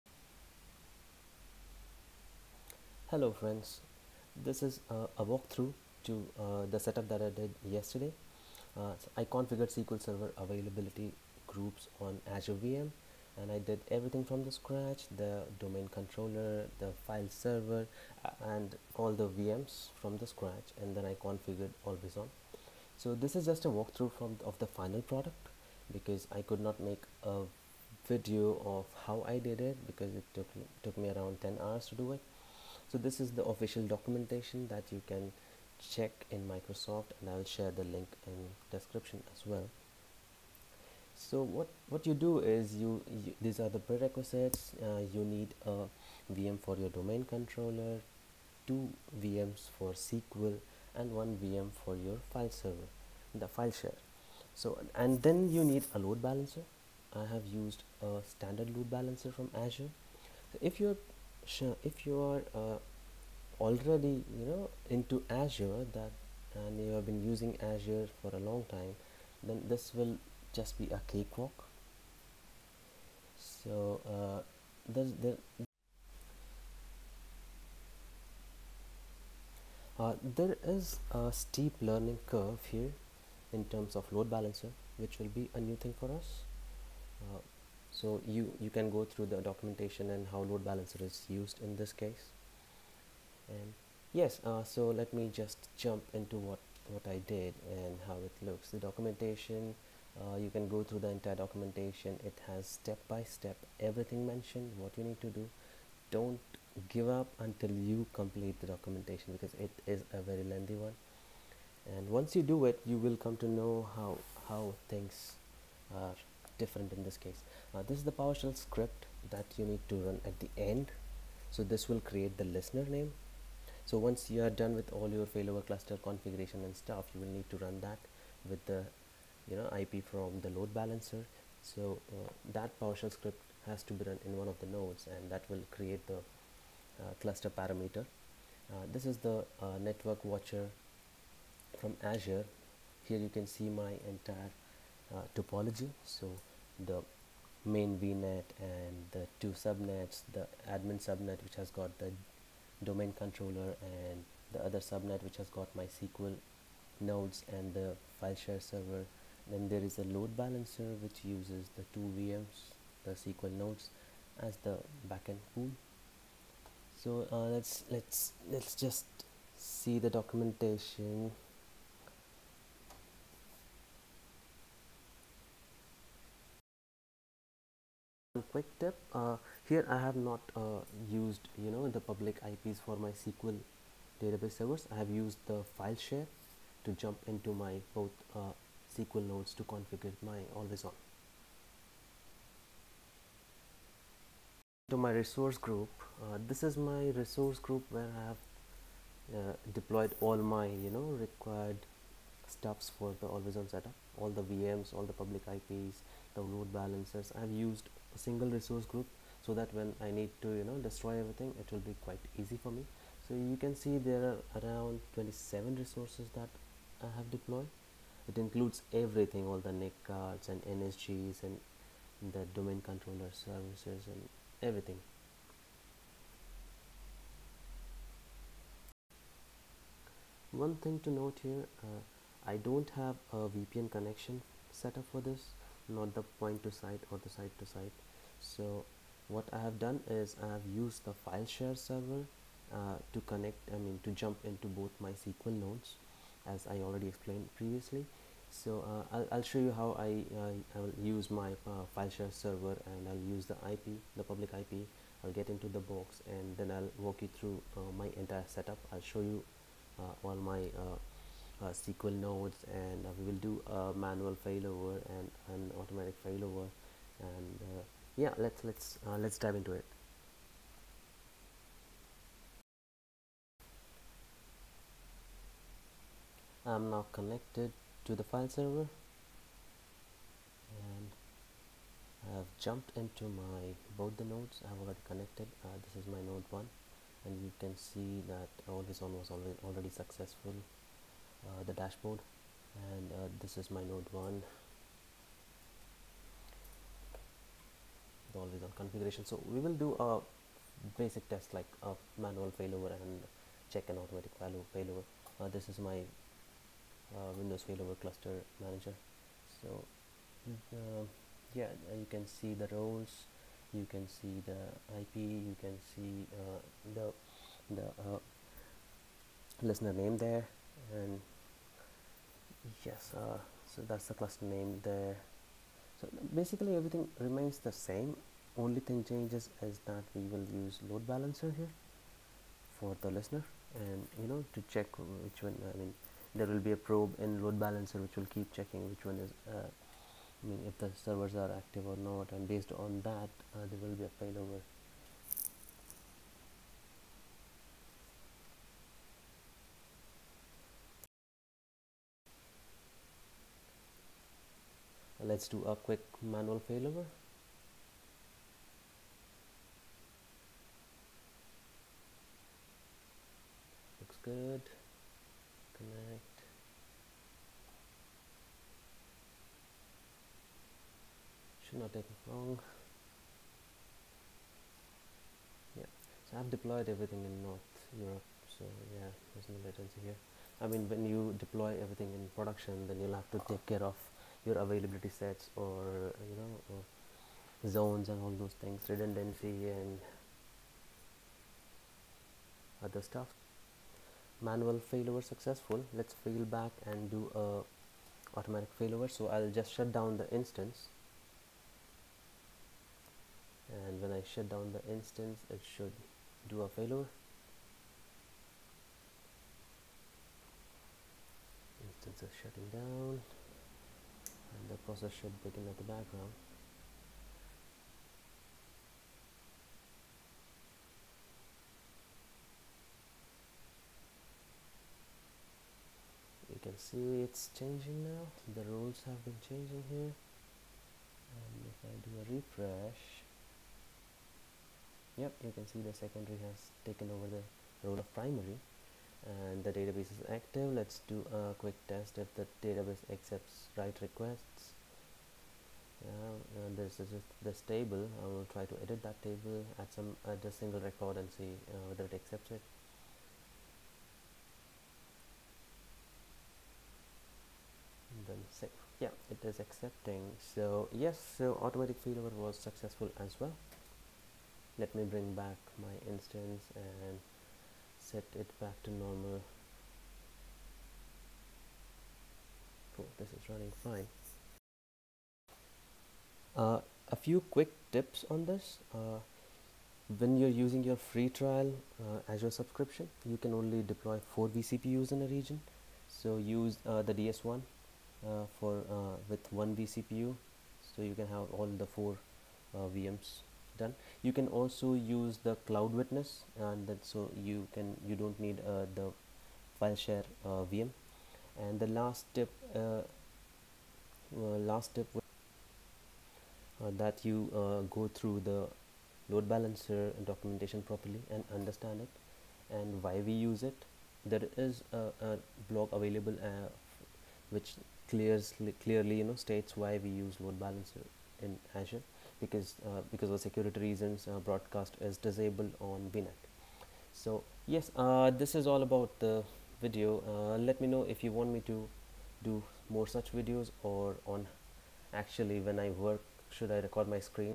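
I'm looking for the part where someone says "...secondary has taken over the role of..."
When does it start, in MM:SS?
07:15.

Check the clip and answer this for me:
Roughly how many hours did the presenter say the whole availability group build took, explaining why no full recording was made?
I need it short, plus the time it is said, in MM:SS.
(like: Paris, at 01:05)
10, at 00:31.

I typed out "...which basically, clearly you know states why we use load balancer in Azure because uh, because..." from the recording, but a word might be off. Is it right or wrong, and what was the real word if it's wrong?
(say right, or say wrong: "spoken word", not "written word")
wrong: "clearly", not "basically".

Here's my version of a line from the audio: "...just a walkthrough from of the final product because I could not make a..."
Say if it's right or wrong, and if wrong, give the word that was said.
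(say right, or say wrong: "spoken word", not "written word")
right.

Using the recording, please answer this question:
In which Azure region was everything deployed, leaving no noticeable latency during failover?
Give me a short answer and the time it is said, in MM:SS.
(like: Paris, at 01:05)
North Europe, at 06:17.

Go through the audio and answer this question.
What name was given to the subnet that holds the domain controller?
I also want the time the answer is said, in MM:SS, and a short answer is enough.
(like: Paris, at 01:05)
admin subnet, at 02:30.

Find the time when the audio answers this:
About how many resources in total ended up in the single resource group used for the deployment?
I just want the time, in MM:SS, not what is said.
03:35.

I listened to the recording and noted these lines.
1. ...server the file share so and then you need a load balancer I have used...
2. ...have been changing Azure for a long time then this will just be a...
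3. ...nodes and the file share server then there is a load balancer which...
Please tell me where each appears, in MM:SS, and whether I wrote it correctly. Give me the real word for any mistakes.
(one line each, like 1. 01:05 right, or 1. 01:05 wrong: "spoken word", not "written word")
1. 00:52 right
2. 01:06 wrong: "using", not "changing"
3. 02:36 right.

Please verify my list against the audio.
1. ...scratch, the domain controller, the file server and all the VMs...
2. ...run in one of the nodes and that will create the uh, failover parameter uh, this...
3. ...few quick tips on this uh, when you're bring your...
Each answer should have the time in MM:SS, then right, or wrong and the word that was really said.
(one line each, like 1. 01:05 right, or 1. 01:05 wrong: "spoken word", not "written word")
1. 00:14 right
2. 02:14 wrong: "cluster", not "failover"
3. 07:57 wrong: "using", not "bring".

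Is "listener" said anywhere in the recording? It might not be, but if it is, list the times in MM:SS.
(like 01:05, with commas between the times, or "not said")
02:02, 05:19, 05:33.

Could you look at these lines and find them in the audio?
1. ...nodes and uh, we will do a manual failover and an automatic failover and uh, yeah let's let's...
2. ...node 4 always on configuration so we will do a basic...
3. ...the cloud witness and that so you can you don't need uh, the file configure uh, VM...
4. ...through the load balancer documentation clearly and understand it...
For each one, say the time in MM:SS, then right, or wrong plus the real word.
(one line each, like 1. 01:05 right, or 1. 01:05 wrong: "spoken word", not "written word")
1. 04:22 right
2. 04:53 wrong: "1", not "4"
3. 08:15 wrong: "share", not "configure"
4. 08:28 wrong: "properly", not "clearly".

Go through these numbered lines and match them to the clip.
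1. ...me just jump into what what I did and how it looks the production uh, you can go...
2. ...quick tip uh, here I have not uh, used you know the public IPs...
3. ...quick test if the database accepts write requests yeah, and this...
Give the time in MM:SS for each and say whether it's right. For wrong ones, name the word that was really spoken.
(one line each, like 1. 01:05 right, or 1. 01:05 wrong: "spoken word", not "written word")
1. 01:35 wrong: "documentation", not "production"
2. 02:58 right
3. 07:21 right.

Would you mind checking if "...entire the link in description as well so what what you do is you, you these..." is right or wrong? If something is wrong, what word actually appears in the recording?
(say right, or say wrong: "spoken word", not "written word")
wrong: "share", not "entire".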